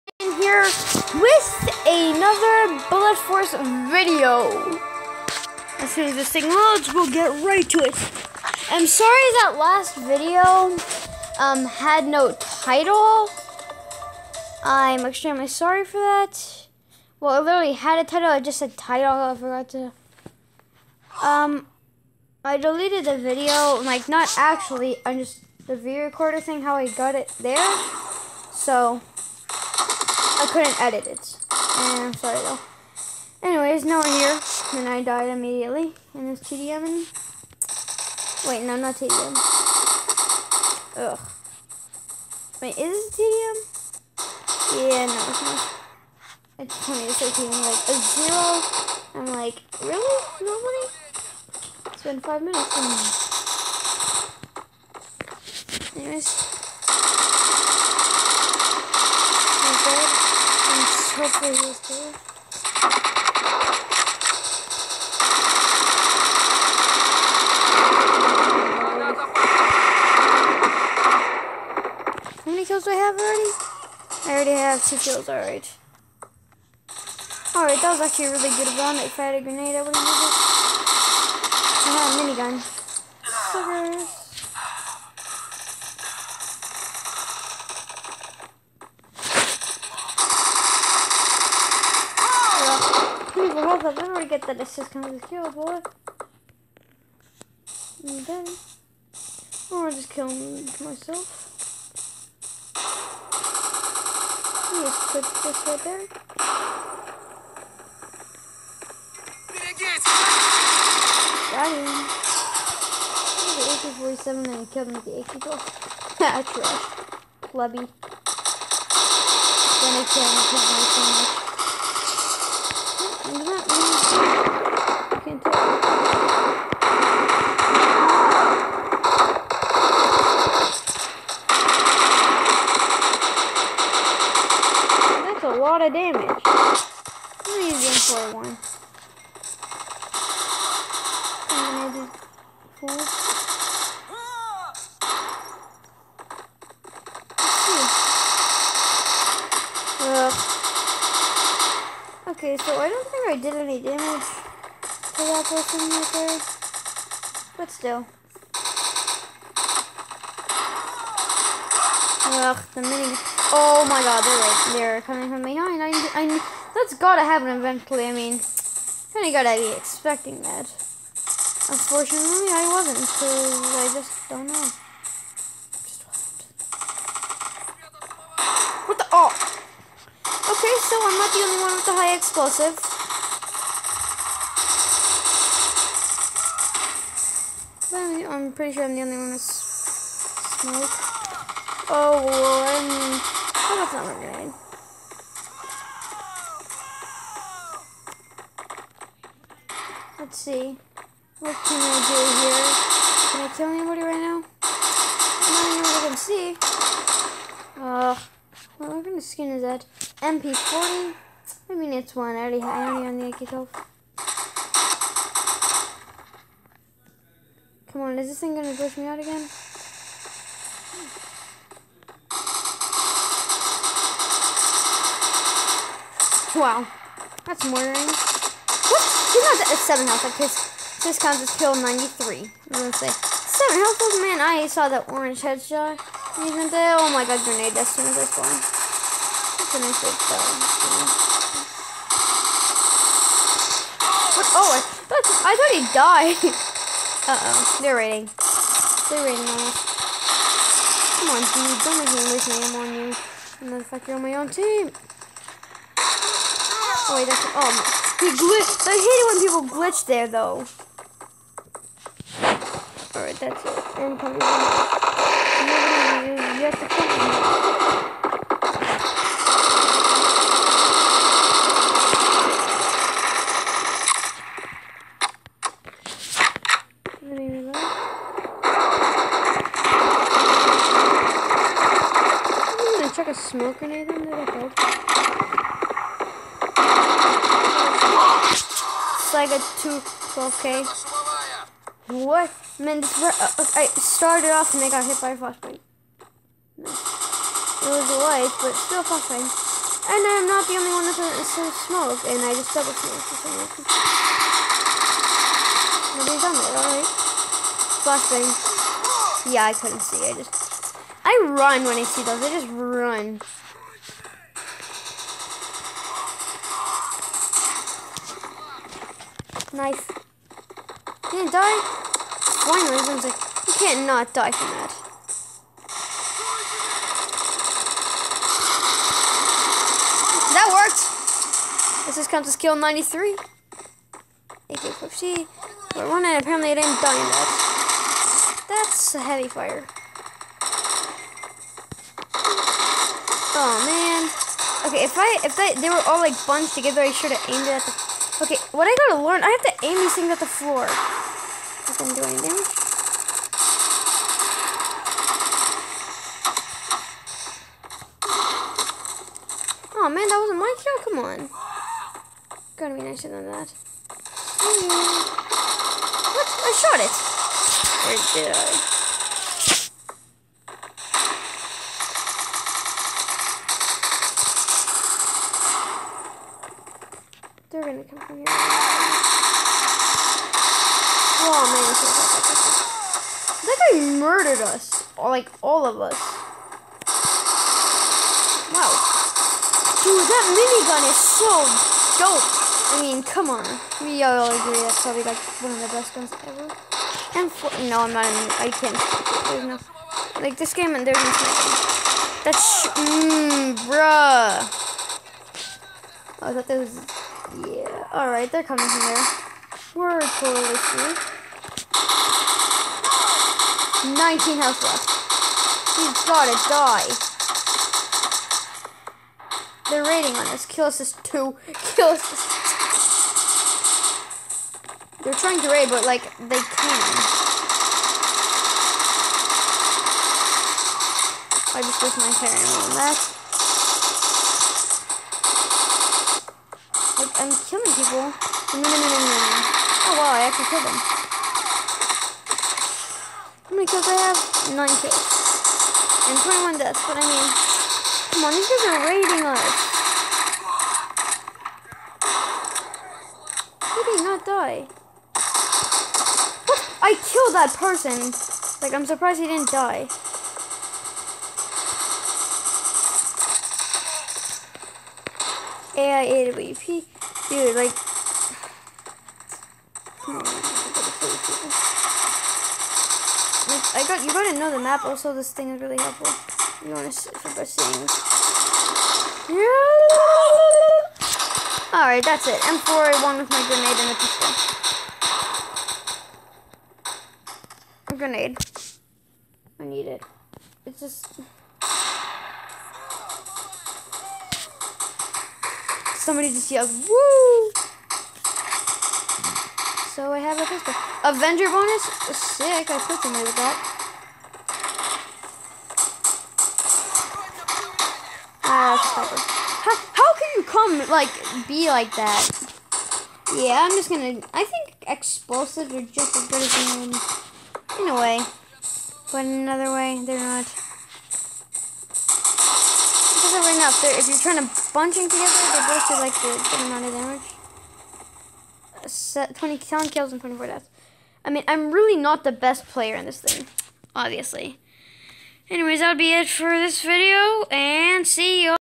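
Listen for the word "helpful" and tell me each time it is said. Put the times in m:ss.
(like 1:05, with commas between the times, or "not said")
7:55.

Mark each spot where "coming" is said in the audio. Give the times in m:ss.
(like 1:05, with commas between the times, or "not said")
2:45, 6:48.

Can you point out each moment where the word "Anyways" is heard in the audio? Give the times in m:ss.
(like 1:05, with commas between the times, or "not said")
0:33, 0:55, 8:55.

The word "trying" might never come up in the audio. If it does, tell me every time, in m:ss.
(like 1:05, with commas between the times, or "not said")
7:05, 8:44.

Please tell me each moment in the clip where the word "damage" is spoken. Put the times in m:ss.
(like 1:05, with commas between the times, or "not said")
2:33, 8:47.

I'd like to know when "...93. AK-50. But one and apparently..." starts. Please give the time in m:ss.
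5:32.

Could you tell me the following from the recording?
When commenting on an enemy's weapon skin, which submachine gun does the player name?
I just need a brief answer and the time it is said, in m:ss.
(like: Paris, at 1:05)
MP40, at 3:30.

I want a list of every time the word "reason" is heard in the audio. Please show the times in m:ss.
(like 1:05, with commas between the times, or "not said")
5:03, 5:22.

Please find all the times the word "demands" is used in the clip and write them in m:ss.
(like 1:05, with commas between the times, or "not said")
not said.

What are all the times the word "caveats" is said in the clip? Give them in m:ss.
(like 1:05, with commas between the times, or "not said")
not said.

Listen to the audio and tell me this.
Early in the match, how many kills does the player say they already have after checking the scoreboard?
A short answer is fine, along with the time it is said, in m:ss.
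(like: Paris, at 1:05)
2, at 1:14.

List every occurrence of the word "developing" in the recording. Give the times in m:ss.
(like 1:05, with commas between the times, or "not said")
not said.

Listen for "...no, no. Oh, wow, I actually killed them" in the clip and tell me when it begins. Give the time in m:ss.
7:18.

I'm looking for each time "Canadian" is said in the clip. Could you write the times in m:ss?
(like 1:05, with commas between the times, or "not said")
not said.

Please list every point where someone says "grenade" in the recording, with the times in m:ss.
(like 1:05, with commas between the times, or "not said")
1:19, 3:14, 3:57, 8:03, 8:08.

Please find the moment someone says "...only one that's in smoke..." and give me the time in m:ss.
5:00.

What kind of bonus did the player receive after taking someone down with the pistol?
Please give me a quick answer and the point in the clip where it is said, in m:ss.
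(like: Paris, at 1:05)
Avenger bonus, at 8:21.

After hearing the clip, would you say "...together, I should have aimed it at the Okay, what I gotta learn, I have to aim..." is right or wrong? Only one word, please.
right.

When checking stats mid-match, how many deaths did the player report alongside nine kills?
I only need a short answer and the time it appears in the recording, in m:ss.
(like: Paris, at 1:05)
21, at 7:26.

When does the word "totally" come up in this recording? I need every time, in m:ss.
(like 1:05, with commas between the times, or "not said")
6:50.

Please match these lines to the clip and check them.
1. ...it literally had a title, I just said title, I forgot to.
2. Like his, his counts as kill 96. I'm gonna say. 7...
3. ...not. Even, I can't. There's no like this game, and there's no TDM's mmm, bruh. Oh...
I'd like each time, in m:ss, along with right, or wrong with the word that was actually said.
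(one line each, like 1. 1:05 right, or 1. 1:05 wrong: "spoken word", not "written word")
1. 0:17 right
2. 3:50 wrong: "93", not "96"
3. 6:38 wrong: "That", not "TDM".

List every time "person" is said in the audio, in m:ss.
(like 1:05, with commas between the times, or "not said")
2:35, 7:37.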